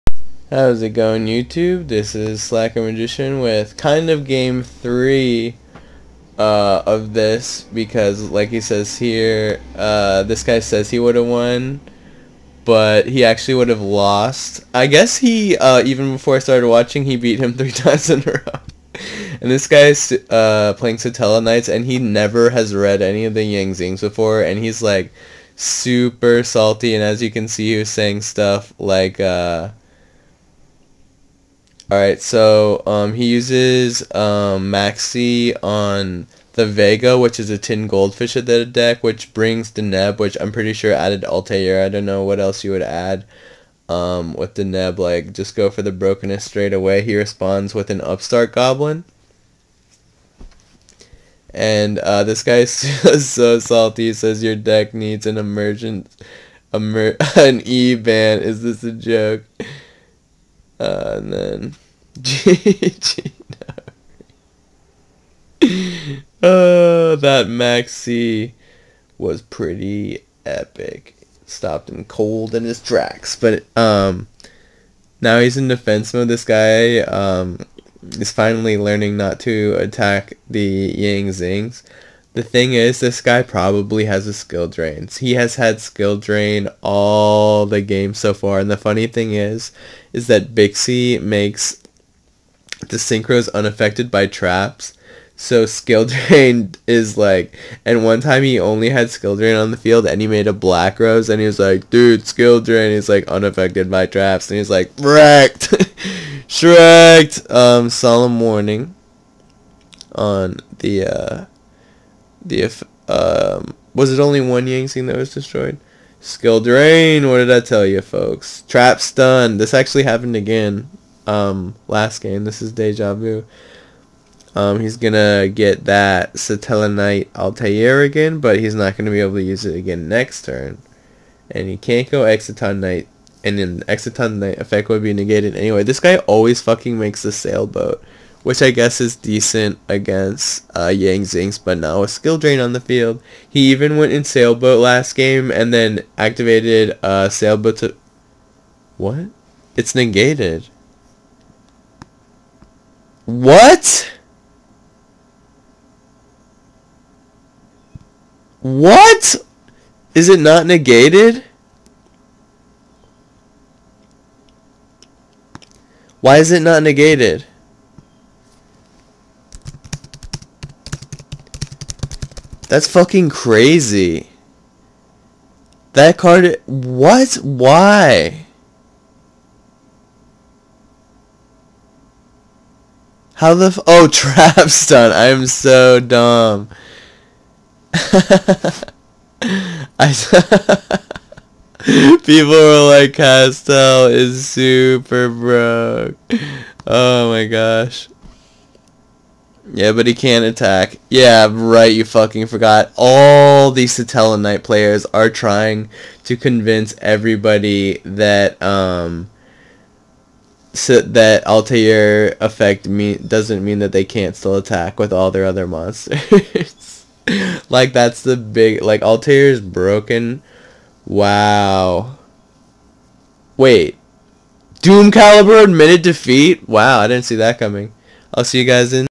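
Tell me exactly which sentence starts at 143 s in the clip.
He even went in Sailboat last game and then activated uh, Sailboat to...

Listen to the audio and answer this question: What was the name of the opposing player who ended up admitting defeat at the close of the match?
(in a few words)
Doom Caliber.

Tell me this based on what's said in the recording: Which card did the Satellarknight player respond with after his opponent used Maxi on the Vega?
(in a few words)
Upstart Goblin.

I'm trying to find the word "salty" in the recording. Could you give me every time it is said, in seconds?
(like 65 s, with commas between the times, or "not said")
26 s, 53 s.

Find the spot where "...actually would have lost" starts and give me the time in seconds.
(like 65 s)
13 s.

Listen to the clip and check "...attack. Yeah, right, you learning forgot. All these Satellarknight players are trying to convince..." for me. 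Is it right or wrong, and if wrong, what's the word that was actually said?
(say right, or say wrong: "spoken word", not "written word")
wrong: "fucking", not "learning".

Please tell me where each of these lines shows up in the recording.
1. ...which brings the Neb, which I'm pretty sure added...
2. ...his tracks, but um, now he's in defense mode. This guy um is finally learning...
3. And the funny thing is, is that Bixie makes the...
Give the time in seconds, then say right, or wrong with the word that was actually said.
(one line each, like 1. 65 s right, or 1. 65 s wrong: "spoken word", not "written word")
1. 39 s right
2. 72 s right
3. 88 s right.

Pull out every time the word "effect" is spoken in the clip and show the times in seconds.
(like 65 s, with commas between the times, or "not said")
134 s, 212 s.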